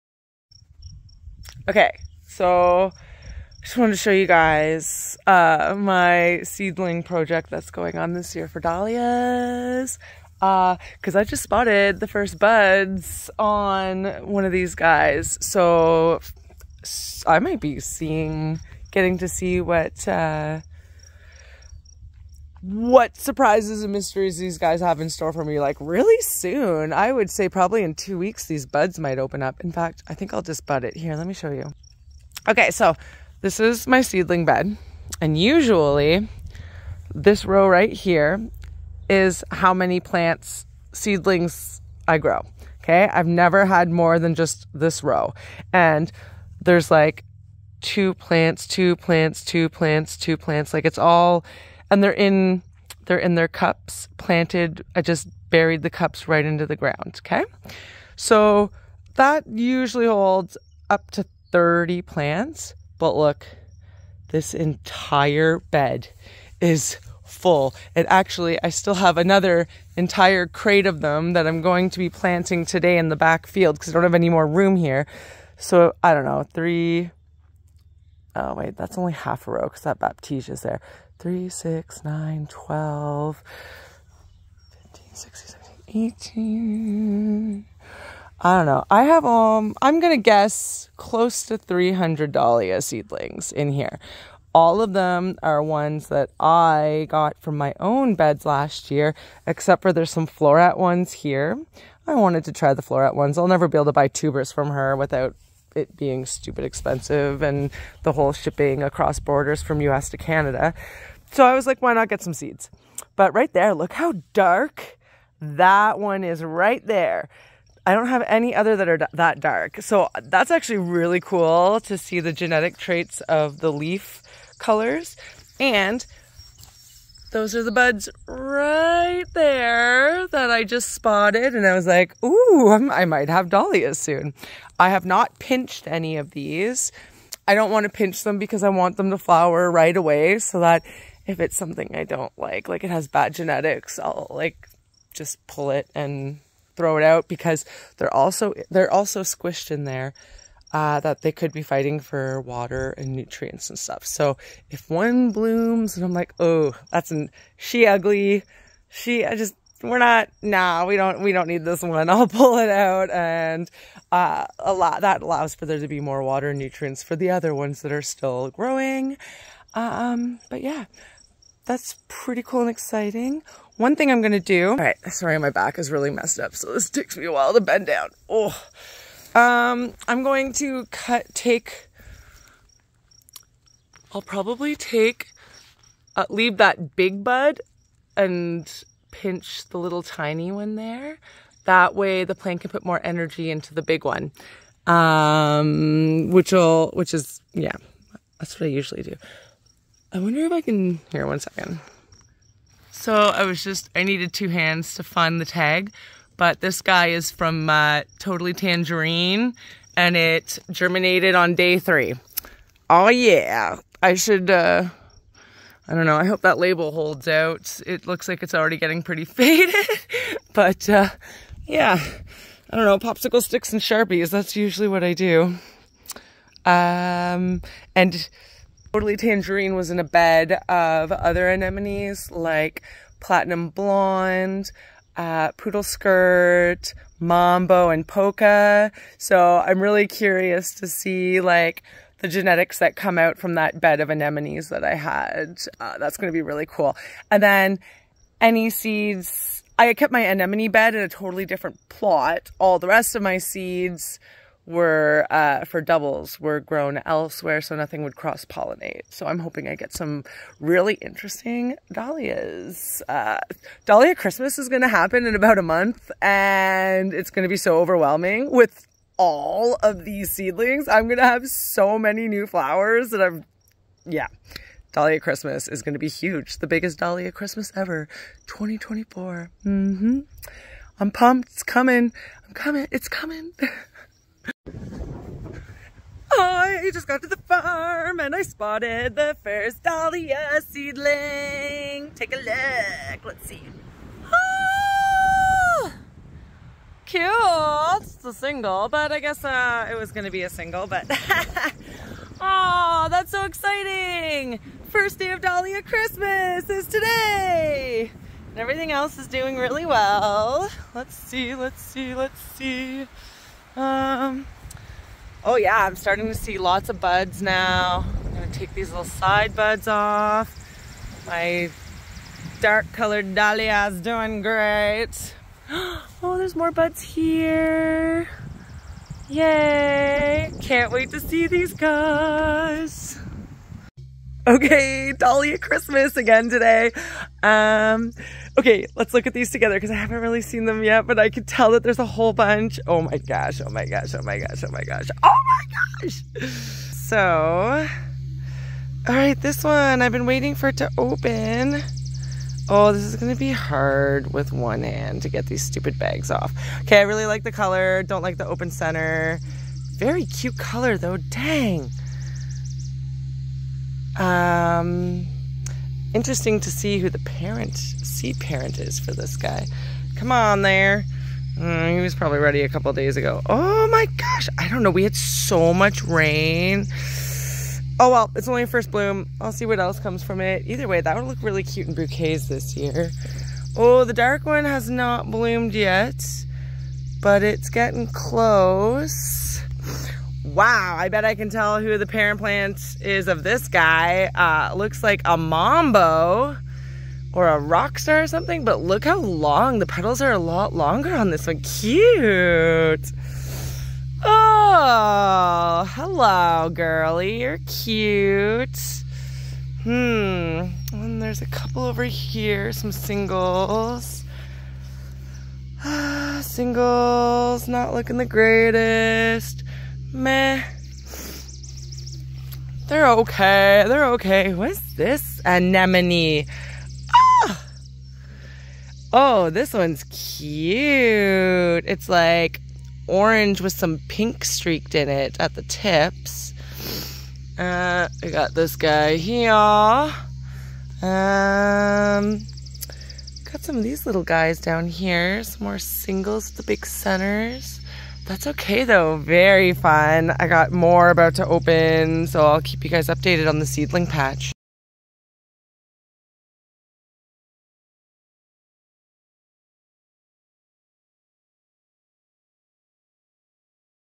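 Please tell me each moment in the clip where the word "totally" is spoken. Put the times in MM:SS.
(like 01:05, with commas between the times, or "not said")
03:28, 03:48, 04:11.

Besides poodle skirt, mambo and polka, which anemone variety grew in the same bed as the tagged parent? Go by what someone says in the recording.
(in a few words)
Platinum Blonde.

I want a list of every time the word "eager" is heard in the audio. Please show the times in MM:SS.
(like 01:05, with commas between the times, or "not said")
not said.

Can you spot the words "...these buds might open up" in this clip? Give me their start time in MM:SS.
00:28.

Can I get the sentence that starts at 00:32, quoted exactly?
Okay, so this is my seedling bed.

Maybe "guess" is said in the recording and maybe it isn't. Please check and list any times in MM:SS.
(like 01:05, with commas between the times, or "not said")
01:30, 04:59.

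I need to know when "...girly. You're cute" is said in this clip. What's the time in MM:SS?
06:46.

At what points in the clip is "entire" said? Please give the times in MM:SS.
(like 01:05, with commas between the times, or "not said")
01:04, 01:09.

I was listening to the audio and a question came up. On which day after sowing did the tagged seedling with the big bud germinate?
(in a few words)
day 3.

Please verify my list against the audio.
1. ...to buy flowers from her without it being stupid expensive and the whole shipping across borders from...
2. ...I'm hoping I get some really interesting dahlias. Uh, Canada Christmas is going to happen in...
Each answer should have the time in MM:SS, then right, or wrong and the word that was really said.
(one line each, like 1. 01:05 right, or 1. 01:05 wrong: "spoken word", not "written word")
1. 01:43 wrong: "tubers", not "flowers"
2. 04:19 wrong: "Dahlia", not "Canada".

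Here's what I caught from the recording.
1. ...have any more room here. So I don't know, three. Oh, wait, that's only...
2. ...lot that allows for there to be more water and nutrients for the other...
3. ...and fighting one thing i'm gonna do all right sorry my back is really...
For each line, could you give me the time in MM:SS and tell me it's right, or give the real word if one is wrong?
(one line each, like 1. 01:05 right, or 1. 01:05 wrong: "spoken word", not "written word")
1. 01:14 right
2. 02:44 right
3. 02:52 wrong: "exciting", not "fighting".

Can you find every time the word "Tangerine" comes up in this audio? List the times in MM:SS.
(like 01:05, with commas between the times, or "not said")
03:28, 03:49.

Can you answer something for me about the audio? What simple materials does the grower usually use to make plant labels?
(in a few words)
Popsicle sticks and Sharpies.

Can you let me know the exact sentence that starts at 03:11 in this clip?
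That way the plant can put more energy into the big one.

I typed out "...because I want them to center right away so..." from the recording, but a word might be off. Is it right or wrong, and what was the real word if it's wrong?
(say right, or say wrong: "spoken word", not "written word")
wrong: "flower", not "center".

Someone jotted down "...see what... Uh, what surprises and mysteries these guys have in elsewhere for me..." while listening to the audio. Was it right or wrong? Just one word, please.
wrong.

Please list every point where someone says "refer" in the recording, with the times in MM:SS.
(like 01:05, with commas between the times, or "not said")
not said.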